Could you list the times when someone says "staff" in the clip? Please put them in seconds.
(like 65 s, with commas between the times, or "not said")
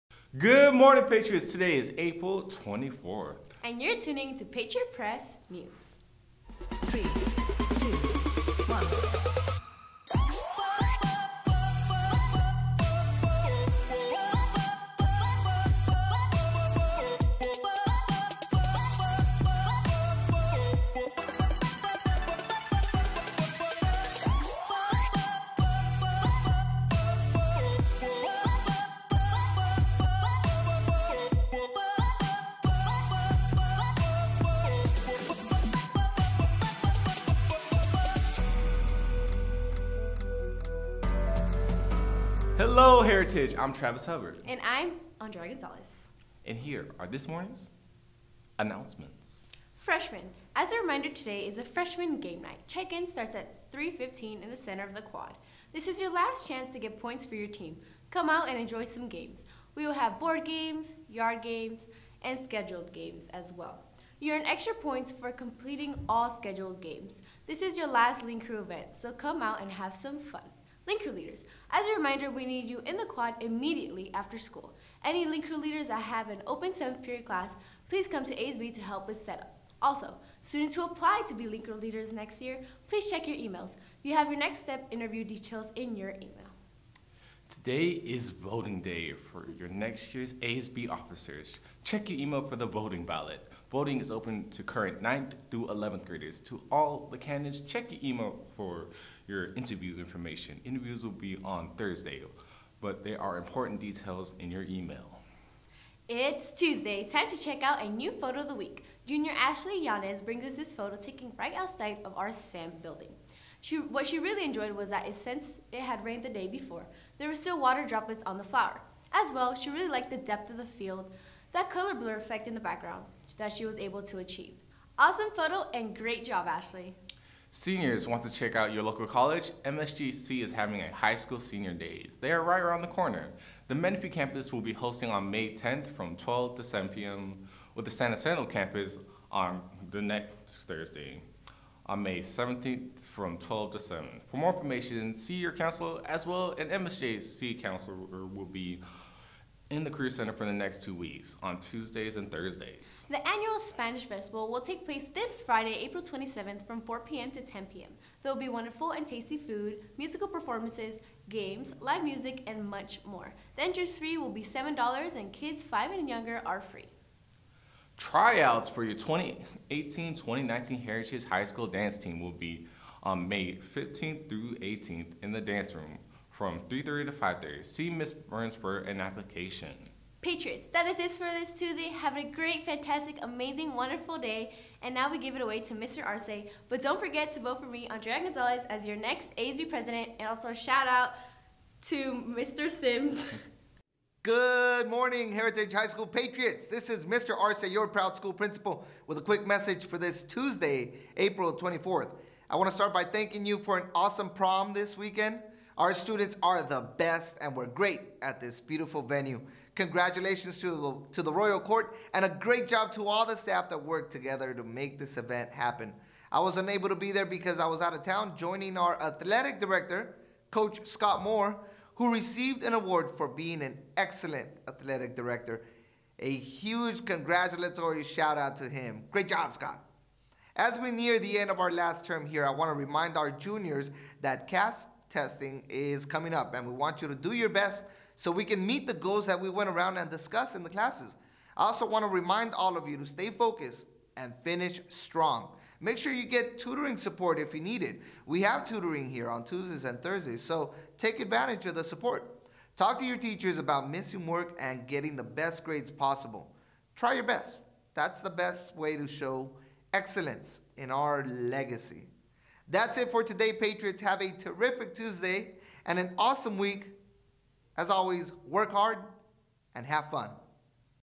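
213 s.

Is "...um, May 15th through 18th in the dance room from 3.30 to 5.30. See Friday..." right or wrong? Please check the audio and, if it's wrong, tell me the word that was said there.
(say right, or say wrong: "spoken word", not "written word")
wrong: "Miss", not "Friday".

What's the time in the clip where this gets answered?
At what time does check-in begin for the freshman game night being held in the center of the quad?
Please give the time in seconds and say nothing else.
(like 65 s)
53 s.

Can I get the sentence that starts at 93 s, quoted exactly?
Voting is open to current 9th through 11th graders.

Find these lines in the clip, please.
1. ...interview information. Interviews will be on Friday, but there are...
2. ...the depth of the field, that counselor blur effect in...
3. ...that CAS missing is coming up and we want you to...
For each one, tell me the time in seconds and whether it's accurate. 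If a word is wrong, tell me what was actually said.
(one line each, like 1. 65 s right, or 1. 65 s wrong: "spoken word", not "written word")
1. 99 s wrong: "Thursday", not "Friday"
2. 120 s wrong: "color", not "counselor"
3. 234 s wrong: "testing", not "missing".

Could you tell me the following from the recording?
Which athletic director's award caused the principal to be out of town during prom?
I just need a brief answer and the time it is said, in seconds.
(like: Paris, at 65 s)
Scott Moore, at 220 s.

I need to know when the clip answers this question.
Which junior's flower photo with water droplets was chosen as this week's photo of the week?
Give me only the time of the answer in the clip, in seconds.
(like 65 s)
109 s.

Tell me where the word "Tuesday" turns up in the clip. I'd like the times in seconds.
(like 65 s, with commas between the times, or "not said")
106 s, 151 s, 181 s, 200 s, 249 s, 264 s.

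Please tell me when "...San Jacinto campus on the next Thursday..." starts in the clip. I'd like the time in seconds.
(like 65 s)
137 s.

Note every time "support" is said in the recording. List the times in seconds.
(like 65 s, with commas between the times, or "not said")
246 s, 251 s.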